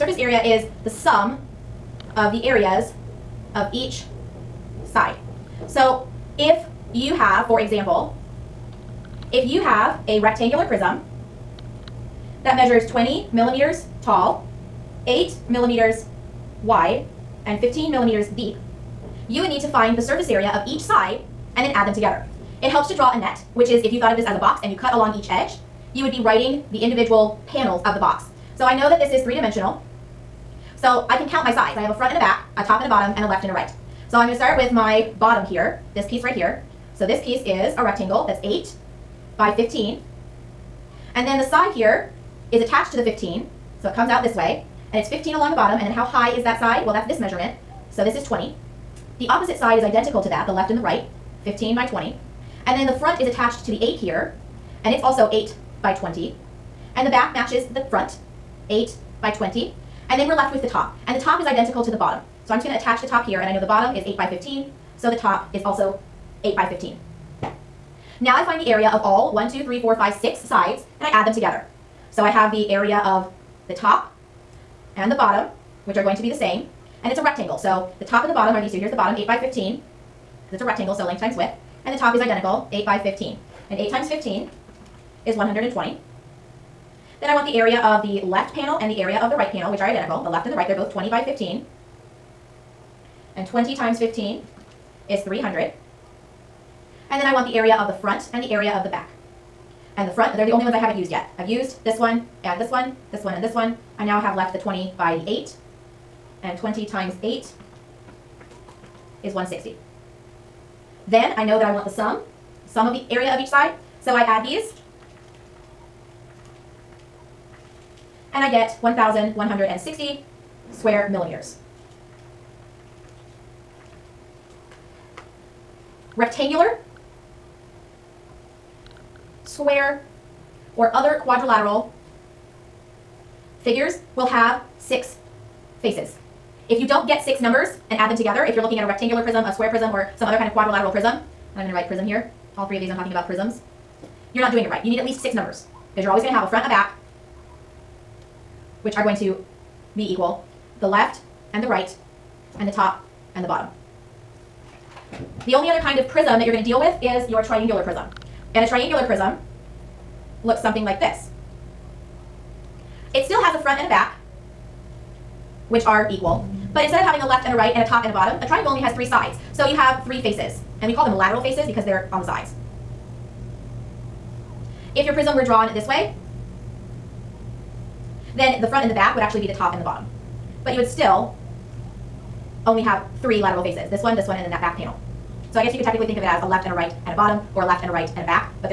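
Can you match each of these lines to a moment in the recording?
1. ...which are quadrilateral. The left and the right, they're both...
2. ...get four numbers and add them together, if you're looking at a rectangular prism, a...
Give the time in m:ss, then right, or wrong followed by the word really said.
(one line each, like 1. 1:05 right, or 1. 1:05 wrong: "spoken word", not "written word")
1. 1:29 wrong: "identical", not "quadrilateral"
2. 2:17 wrong: "six", not "four".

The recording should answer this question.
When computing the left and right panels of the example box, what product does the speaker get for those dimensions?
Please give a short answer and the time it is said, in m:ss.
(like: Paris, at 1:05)
300, at 1:35.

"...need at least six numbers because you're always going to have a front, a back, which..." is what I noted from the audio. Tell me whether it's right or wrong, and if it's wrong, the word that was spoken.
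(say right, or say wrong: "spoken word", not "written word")
right.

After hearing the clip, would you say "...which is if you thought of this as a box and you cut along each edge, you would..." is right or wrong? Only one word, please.
right.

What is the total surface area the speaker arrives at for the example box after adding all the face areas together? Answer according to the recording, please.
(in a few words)
1,160 square millimeters.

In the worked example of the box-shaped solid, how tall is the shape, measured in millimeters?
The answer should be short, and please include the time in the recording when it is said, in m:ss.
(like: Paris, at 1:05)
20 millimeters, at 0:12.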